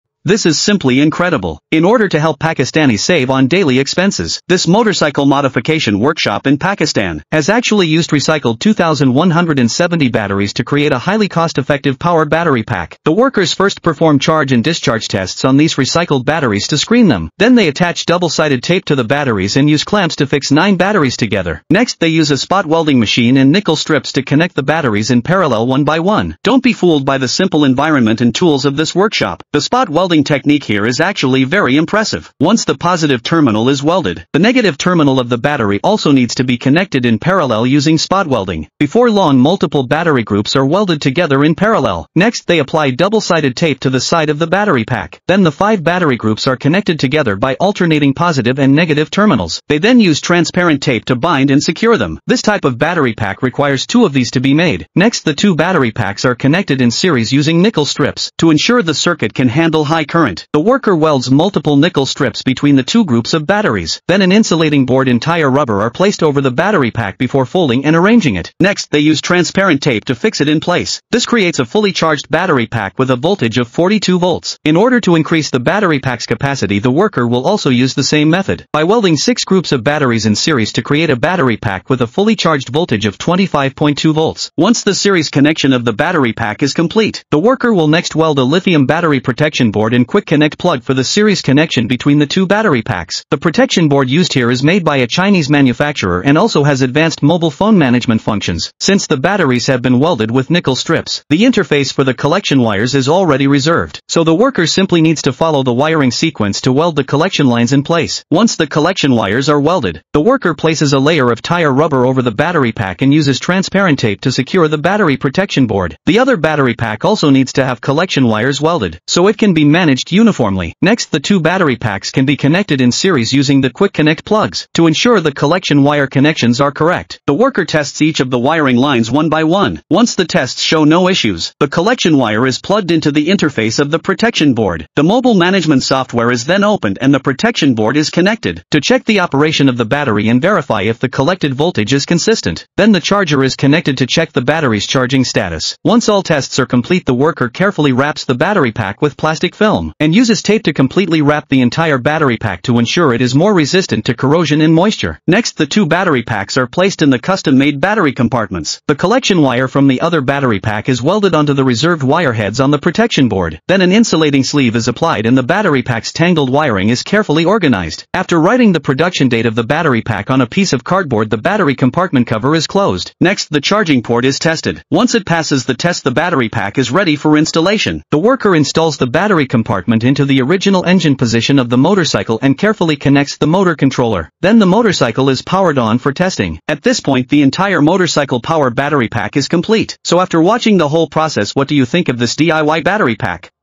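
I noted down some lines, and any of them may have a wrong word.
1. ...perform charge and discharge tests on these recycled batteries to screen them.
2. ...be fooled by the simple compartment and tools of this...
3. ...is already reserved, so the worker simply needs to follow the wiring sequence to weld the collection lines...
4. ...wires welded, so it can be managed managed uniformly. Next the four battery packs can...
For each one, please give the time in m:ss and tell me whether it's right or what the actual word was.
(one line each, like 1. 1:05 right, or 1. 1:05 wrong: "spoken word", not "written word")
1. 0:13 right
2. 0:26 wrong: "environment", not "compartment"
3. 1:42 right
4. 1:58 wrong: "two", not "four".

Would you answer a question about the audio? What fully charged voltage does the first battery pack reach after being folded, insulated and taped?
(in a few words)
42 volts.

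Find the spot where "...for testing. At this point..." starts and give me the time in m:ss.
3:05.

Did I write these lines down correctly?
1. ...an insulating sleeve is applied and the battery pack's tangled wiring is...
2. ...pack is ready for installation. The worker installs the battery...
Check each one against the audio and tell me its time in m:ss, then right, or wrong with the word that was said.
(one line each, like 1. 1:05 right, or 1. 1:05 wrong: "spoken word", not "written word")
1. 2:43 right
2. 2:56 right.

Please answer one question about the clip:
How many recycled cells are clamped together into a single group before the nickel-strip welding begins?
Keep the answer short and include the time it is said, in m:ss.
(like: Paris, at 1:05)
9, at 0:20.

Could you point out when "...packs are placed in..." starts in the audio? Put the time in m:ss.
2:36.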